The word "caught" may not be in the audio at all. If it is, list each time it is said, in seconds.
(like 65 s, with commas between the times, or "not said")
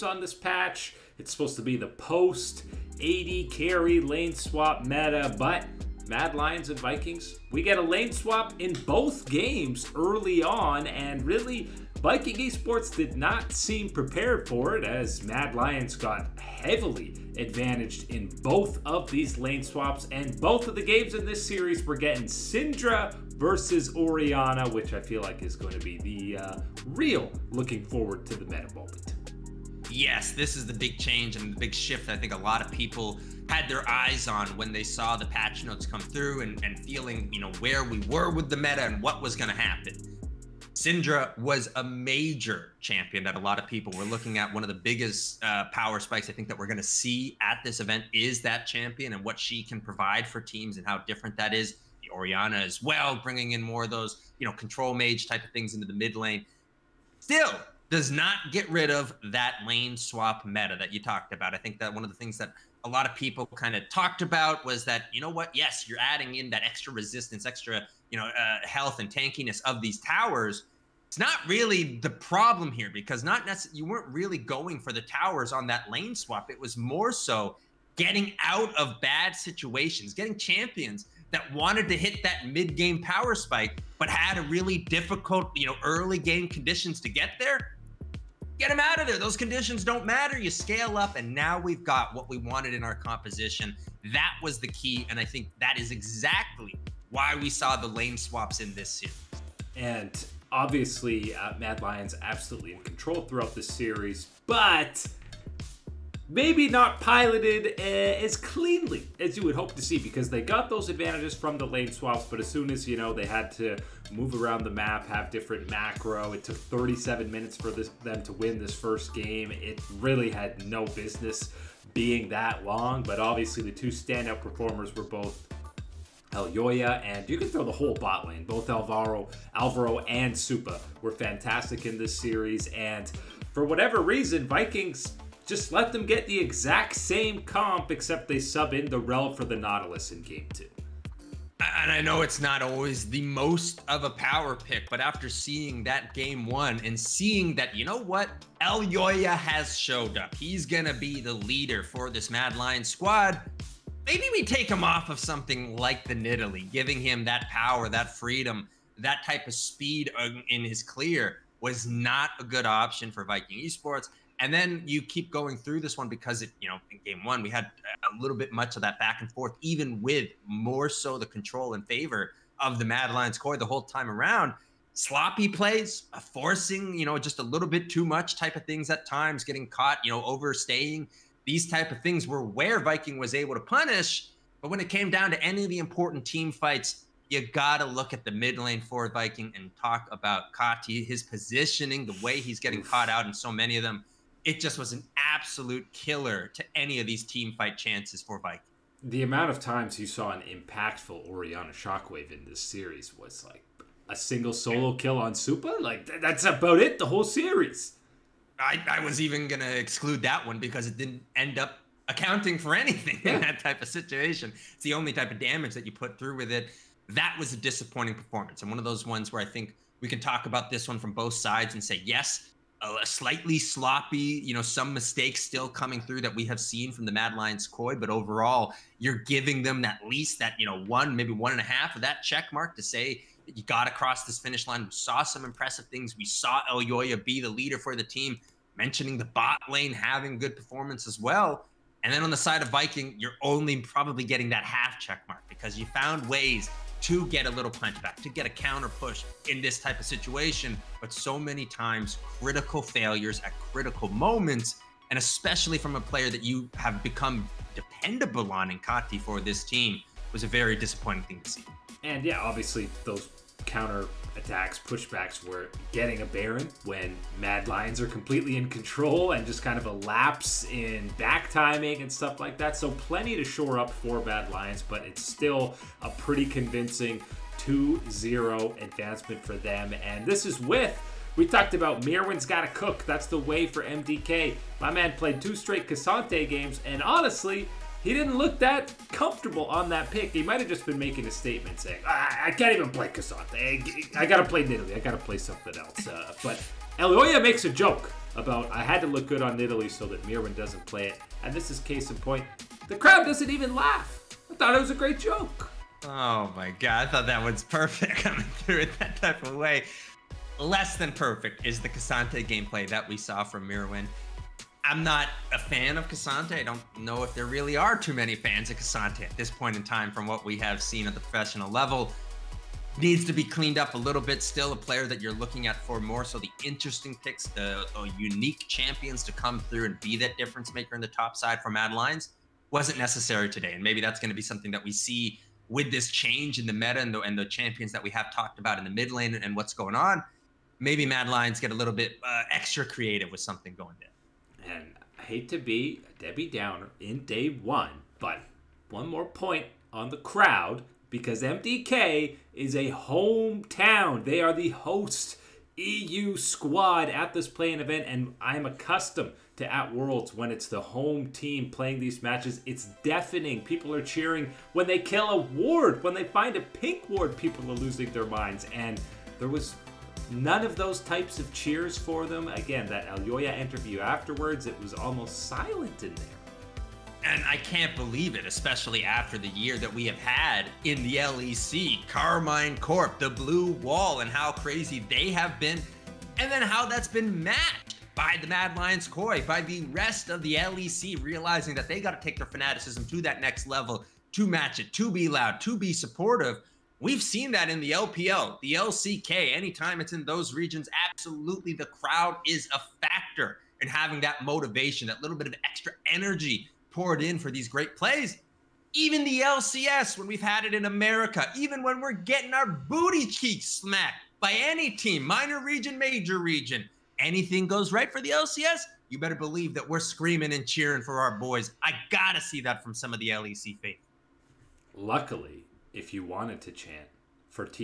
179 s, 192 s.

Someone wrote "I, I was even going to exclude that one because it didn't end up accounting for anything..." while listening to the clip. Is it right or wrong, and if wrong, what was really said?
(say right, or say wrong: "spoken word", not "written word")
right.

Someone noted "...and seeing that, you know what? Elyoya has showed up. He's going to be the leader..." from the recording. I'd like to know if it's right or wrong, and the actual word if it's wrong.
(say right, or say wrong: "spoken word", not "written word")
right.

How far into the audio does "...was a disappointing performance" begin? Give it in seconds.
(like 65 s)
217 s.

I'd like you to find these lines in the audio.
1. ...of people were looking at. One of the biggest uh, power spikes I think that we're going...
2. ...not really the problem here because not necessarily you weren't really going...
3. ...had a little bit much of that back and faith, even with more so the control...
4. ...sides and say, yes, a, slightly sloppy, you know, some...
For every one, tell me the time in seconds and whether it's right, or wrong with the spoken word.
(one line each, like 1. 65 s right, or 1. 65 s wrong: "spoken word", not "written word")
1. 43 s right
2. 71 s right
3. 167 s wrong: "forth", not "faith"
4. 221 s right.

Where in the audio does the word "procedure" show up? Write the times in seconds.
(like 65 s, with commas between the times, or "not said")
not said.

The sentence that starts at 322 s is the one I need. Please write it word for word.
Needs to be cleaned up a little bit.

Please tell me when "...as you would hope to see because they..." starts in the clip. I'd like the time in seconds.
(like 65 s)
109 s.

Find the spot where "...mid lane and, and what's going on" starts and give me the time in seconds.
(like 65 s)
338 s.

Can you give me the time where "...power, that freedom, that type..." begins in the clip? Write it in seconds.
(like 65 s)
157 s.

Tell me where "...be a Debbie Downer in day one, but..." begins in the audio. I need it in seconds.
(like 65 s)
345 s.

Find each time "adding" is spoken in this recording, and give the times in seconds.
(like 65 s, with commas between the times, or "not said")
65 s.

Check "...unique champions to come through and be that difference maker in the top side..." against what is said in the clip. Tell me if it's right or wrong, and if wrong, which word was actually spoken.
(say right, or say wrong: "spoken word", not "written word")
right.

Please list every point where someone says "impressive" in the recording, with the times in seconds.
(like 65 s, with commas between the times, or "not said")
235 s.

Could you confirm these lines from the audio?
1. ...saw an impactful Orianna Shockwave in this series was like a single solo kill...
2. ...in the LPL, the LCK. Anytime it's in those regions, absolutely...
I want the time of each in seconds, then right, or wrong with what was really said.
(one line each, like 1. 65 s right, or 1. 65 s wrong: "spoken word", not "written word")
1. 200 s right
2. 397 s right.